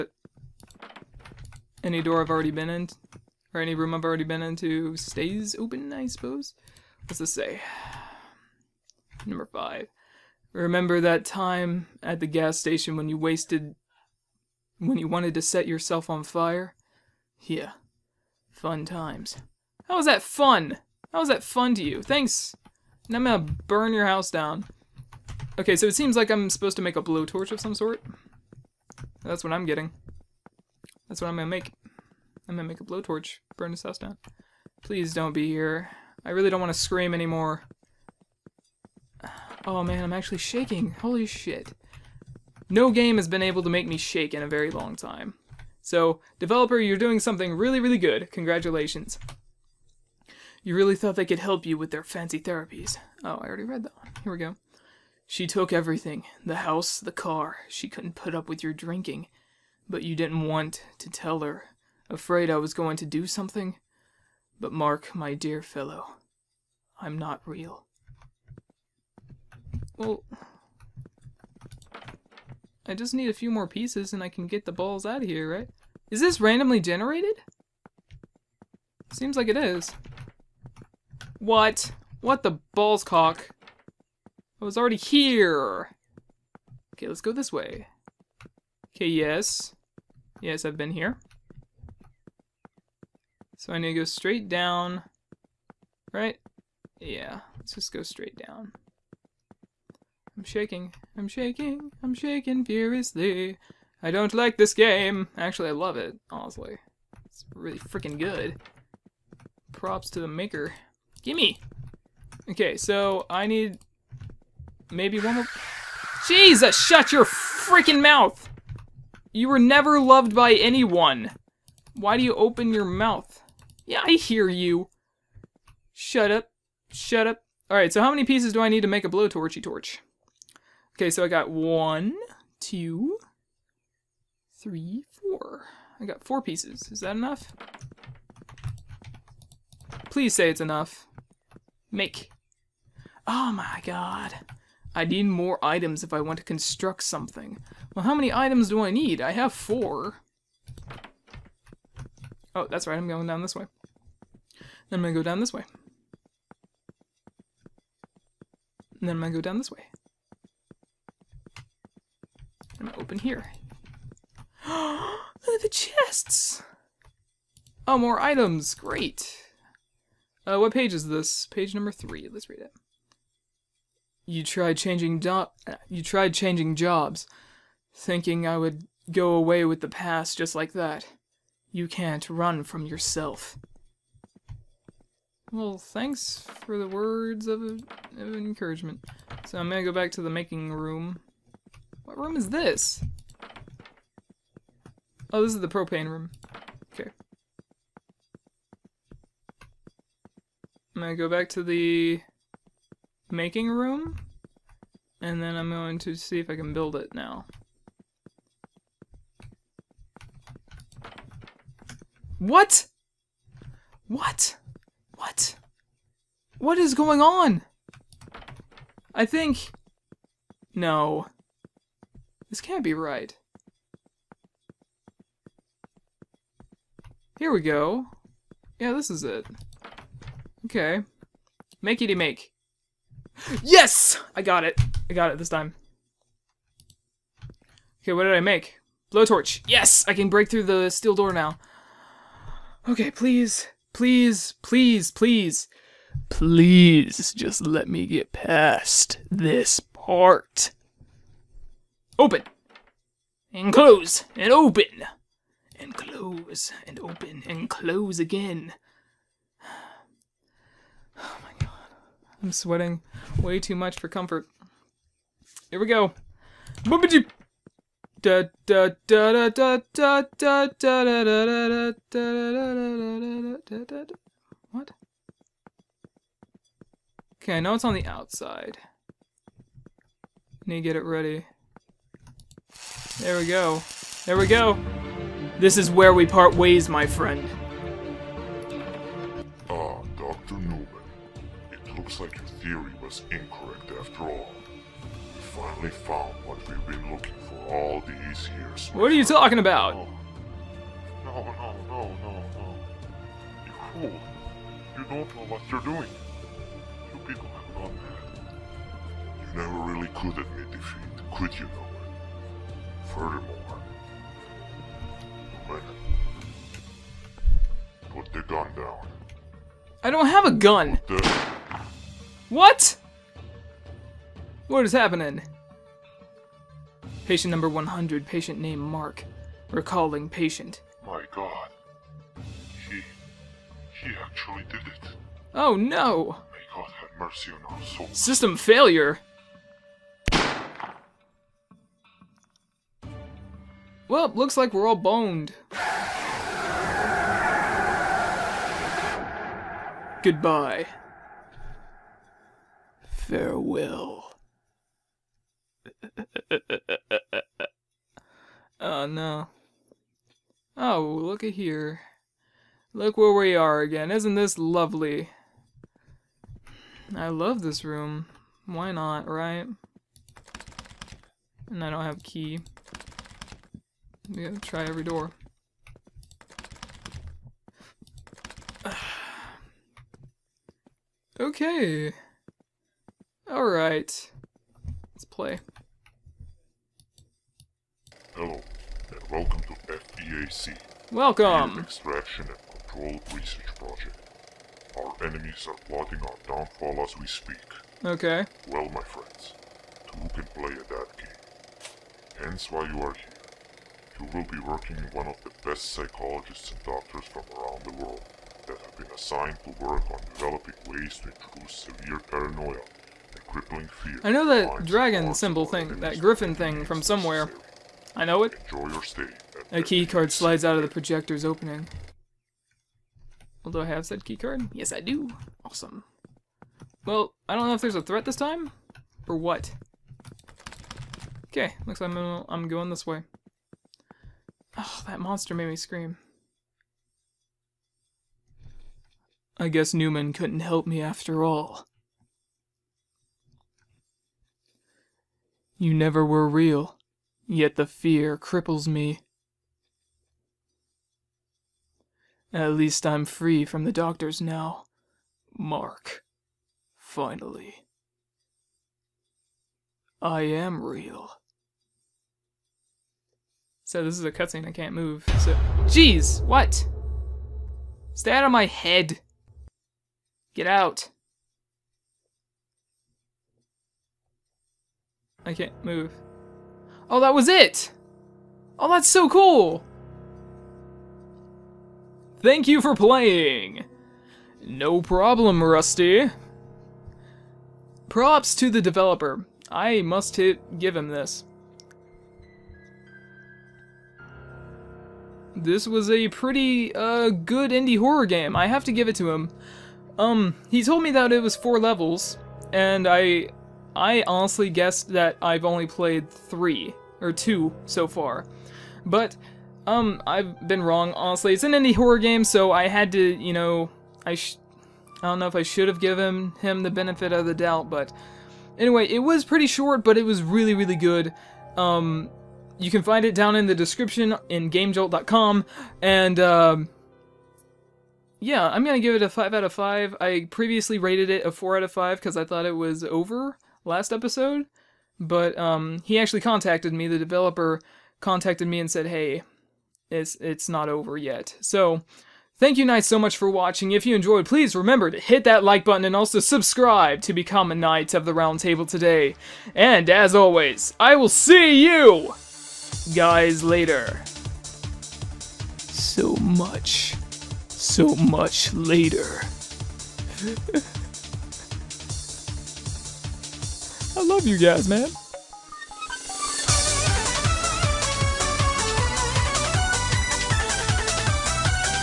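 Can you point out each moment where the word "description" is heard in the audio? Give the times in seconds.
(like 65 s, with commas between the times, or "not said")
523 s.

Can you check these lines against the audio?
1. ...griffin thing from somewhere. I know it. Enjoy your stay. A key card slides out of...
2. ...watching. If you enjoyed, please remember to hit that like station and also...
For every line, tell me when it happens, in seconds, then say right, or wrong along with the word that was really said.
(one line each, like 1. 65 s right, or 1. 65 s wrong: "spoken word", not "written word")
1. 416 s right
2. 543 s wrong: "button", not "station".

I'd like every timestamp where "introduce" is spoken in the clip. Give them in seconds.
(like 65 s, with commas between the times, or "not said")
411 s.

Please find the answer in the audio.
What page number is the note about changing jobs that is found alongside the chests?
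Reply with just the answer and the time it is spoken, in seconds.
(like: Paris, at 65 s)
3, at 171 s.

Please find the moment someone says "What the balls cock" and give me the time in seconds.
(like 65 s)
82 s.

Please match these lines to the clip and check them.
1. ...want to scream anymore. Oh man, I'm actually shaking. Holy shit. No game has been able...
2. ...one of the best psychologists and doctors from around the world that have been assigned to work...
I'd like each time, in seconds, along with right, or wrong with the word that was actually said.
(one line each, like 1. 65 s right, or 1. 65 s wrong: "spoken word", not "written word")
1. 36 s right
2. 405 s right.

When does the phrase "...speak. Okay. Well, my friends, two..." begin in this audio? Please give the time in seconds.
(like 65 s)
397 s.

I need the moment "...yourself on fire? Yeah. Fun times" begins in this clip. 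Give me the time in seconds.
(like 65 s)
15 s.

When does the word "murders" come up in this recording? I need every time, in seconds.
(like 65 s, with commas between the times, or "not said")
not said.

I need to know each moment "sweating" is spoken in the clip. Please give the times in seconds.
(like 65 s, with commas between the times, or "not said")
262 s.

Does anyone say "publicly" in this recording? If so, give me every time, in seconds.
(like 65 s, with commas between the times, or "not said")
not said.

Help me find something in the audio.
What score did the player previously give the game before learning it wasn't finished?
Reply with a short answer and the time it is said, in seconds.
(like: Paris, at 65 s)
4 out of 5, at 531 s.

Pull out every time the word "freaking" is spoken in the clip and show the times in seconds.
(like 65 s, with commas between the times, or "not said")
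107 s, 117 s.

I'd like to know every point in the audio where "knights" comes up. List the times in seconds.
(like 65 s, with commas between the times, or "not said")
542 s, 547 s.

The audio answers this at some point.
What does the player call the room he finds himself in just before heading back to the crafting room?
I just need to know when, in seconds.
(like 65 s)
195 s.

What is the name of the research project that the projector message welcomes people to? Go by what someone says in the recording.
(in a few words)
FEAC.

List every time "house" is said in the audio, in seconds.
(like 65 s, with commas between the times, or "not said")
24 s, 33 s, 56 s.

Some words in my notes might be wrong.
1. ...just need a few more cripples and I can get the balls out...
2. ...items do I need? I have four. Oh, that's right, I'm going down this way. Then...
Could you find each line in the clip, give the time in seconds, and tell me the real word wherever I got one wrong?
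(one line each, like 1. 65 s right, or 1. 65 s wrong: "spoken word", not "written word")
1. 72 s wrong: "pieces", not "cripples"
2. 148 s right.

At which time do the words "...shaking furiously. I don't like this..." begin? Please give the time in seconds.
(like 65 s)
102 s.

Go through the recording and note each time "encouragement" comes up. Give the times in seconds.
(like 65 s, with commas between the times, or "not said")
188 s.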